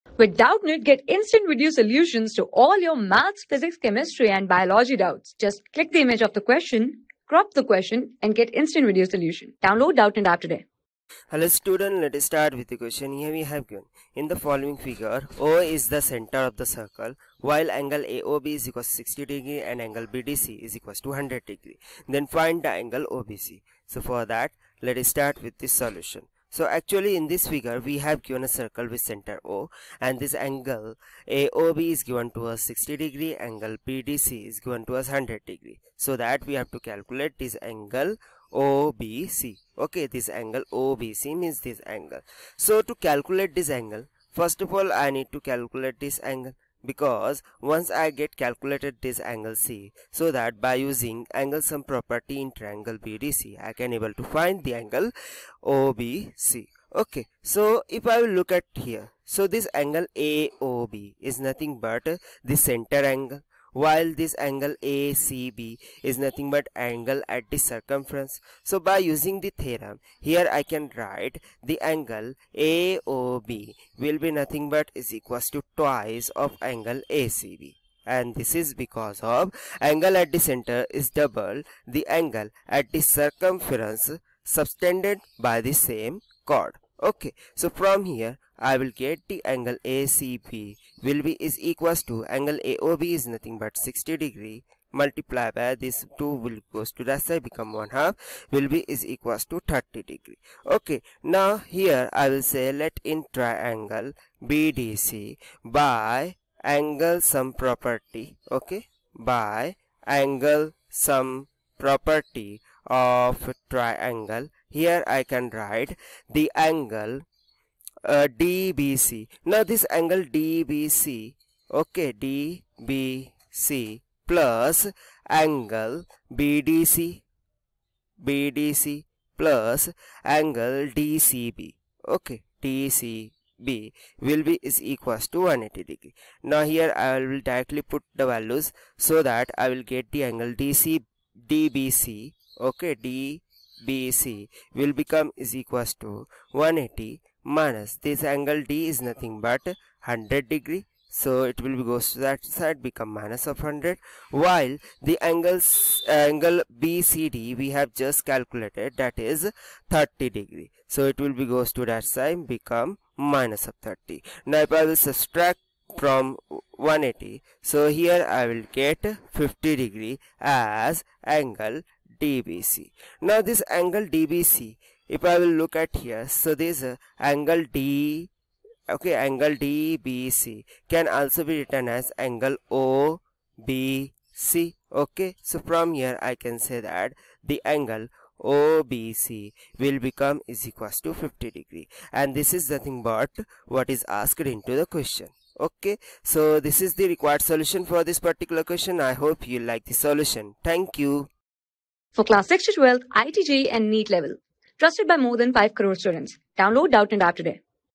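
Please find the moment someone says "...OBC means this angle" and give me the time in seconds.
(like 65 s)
40 s.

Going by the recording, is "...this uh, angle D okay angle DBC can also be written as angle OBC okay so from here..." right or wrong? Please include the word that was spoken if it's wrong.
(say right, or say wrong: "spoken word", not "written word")
right.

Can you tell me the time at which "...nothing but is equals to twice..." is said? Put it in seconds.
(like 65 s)
74 s.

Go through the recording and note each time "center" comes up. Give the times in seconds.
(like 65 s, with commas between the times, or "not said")
16 s, 29 s, 62 s, 80 s.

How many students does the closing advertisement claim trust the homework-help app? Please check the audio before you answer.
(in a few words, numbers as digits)
5 crore.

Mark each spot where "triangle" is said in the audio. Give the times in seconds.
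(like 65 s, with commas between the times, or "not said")
52 s, 103 s, 113 s.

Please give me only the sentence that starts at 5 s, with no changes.
Just click the image of the question, crop the question, and get instant video solution.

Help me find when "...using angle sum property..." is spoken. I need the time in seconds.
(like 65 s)
50 s.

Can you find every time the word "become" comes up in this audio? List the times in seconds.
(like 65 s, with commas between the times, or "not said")
97 s, 144 s, 152 s, 162 s, 190 s.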